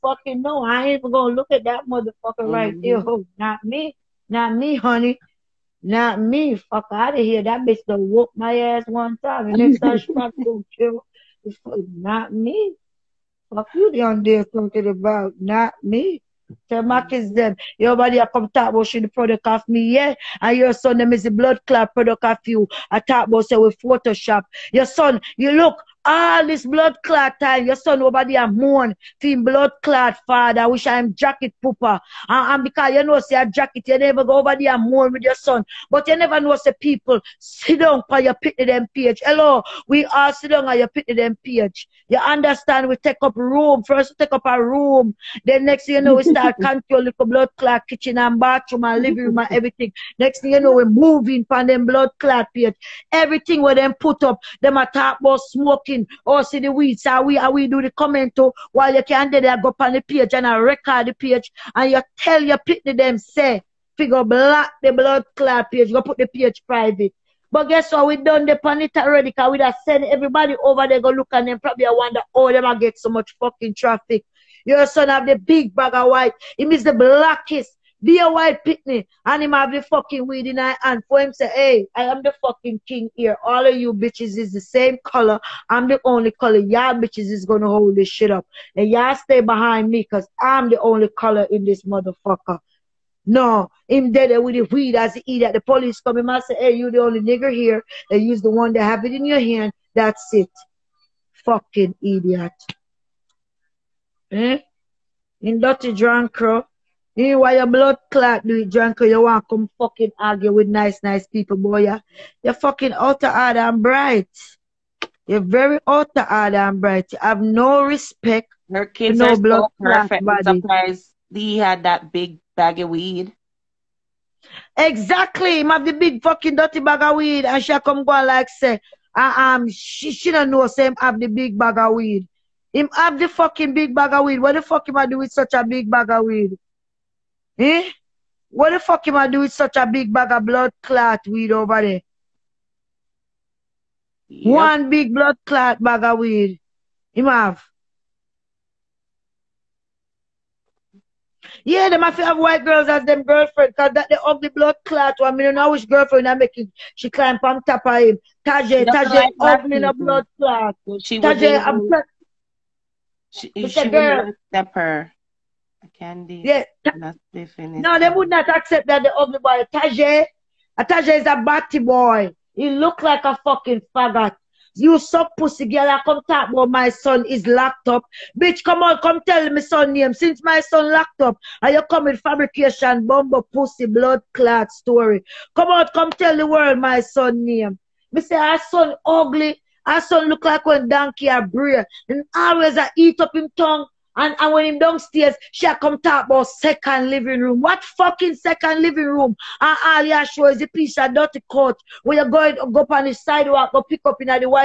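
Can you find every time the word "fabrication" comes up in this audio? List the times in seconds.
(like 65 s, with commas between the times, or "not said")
182 s.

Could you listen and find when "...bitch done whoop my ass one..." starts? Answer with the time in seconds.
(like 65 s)
7 s.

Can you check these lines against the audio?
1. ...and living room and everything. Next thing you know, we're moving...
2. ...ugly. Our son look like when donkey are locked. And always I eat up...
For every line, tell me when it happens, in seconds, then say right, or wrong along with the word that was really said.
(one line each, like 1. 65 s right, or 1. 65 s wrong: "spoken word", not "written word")
1. 48 s right
2. 189 s wrong: "breed", not "locked".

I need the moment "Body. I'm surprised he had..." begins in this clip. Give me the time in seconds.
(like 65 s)
120 s.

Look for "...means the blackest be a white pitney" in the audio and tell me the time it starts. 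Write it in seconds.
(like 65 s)
76 s.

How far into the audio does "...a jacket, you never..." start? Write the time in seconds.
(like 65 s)
33 s.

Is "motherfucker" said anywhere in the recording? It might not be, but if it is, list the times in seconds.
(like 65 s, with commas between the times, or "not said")
1 s, 91 s.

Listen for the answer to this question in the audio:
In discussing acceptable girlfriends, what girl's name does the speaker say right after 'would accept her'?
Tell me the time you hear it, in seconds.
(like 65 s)
165 s.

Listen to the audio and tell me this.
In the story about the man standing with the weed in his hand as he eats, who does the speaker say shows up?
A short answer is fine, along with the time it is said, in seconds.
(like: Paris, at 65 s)
The police, at 95 s.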